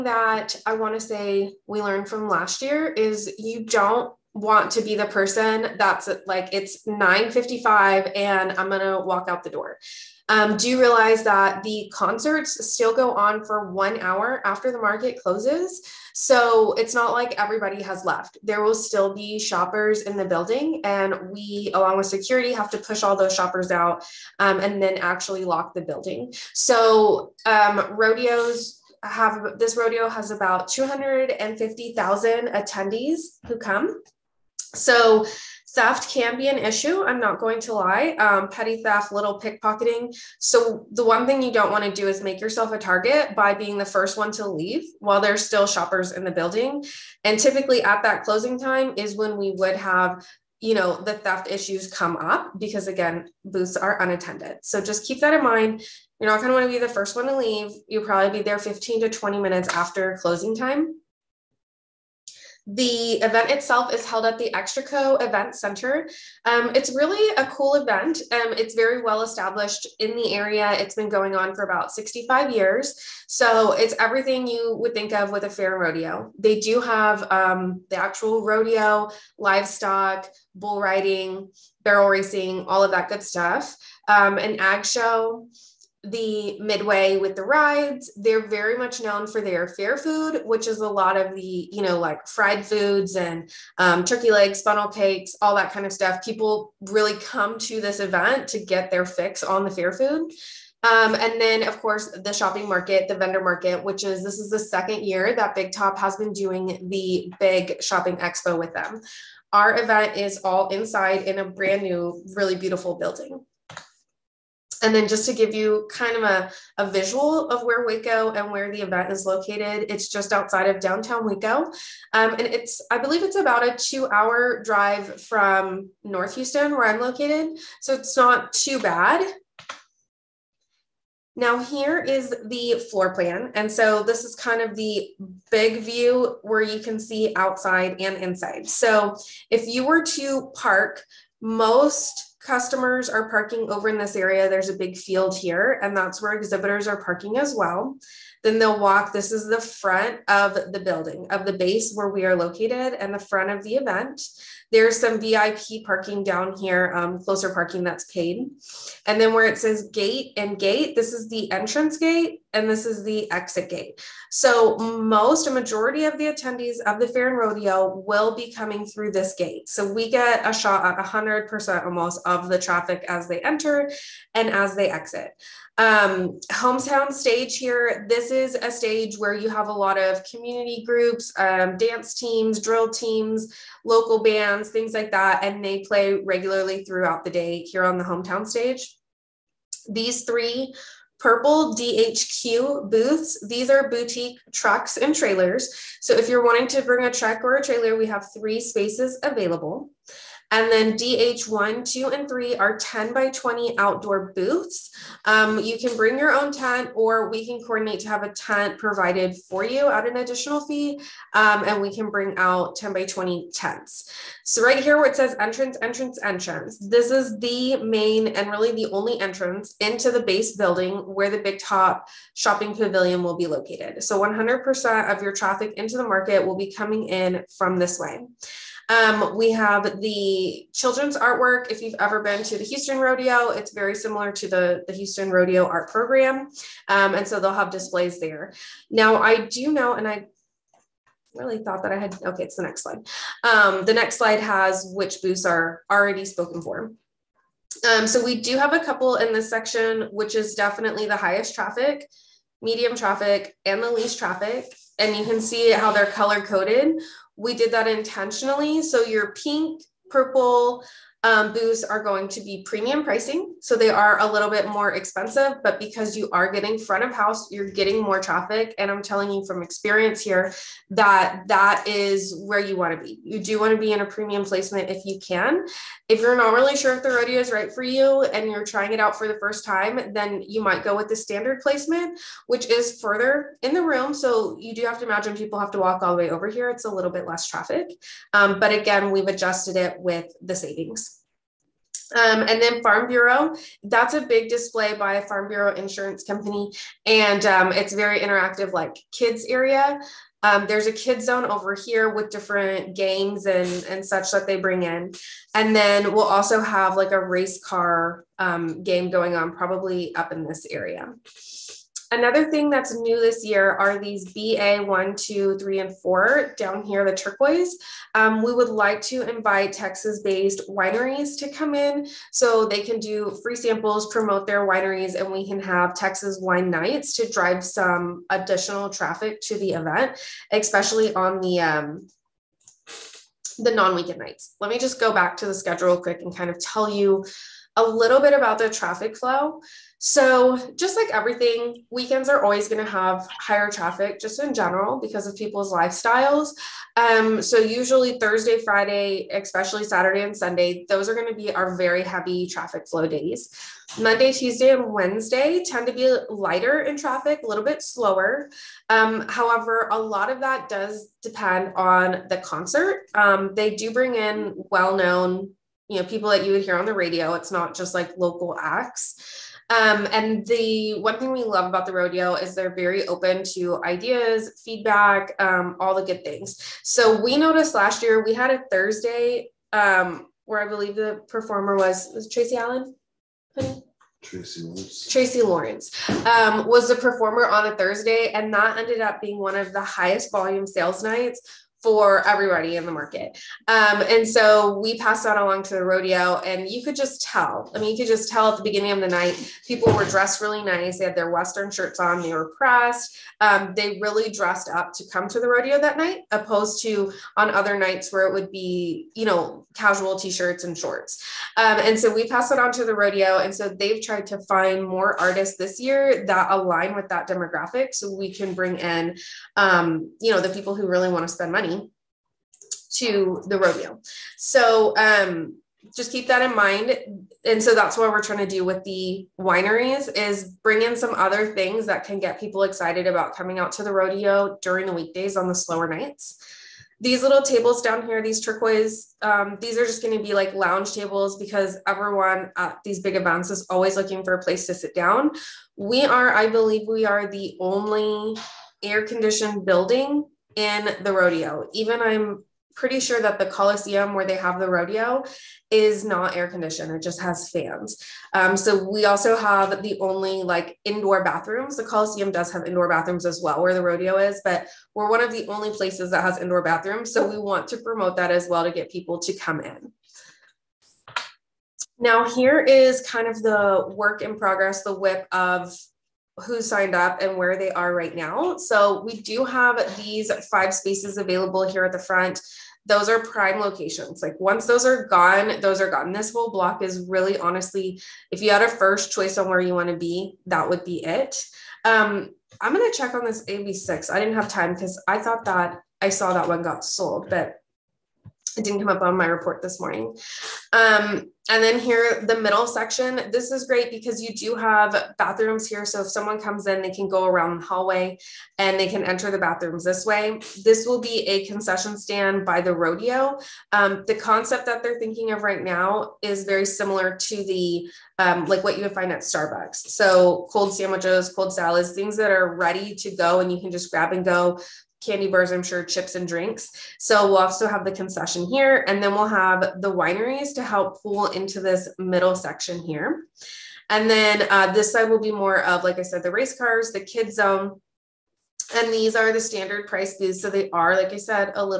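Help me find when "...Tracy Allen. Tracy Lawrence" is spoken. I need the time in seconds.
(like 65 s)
382 s.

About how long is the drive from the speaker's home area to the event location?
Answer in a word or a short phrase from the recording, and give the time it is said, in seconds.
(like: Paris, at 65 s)
2 hours, at 123 s.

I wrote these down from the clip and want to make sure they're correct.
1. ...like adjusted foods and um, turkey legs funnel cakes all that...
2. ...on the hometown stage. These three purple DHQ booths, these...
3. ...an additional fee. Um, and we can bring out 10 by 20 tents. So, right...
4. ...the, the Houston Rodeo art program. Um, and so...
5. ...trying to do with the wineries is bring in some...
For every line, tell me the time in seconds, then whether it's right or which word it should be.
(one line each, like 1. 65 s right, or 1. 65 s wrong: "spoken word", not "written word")
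1. 91 s wrong: "fried", not "adjusted"
2. 187 s right
3. 210 s right
4. 234 s right
5. 428 s right.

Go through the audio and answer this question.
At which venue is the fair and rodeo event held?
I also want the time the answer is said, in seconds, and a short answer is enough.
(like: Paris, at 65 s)
Extraco Event Center, at 64 s.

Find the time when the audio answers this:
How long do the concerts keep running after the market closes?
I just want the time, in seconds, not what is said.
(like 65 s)
13 s.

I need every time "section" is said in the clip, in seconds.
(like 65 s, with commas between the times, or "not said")
249 s, 502 s, 532 s.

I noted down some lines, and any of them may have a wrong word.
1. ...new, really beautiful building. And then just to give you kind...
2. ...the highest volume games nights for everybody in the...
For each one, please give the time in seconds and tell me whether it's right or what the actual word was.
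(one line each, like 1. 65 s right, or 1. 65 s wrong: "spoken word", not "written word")
1. 111 s right
2. 389 s wrong: "sales", not "games".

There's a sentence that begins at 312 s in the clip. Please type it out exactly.
Another thing that's new this year are these BA one, two, three, and four down here, the turquoise.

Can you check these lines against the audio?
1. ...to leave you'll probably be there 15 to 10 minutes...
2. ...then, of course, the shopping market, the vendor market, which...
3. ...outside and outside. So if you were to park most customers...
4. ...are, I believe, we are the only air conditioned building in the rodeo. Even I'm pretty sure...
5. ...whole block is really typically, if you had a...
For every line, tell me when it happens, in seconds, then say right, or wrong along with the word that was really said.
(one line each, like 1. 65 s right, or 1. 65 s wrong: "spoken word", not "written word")
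1. 57 s wrong: "20", not "10"
2. 101 s right
3. 137 s wrong: "inside", not "outside"
4. 446 s right
5. 486 s wrong: "honestly", not "typically".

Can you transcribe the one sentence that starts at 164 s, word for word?
So most, a majority of the attendees of the fair and rodeo will be coming through this gate.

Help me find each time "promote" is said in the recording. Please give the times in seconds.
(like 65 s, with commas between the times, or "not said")
324 s, 467 s.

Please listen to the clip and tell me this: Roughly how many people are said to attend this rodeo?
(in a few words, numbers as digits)
250,000.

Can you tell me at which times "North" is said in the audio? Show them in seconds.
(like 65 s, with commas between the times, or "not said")
126 s.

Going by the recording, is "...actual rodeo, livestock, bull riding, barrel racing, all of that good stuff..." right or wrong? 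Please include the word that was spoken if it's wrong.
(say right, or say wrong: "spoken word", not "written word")
right.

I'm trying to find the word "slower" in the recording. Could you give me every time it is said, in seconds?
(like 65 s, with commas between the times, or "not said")
357 s, 435 s.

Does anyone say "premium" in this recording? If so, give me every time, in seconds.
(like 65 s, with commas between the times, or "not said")
262 s, 274 s.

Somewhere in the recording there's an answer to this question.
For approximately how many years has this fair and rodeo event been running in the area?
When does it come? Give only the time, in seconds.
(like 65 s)
71 s.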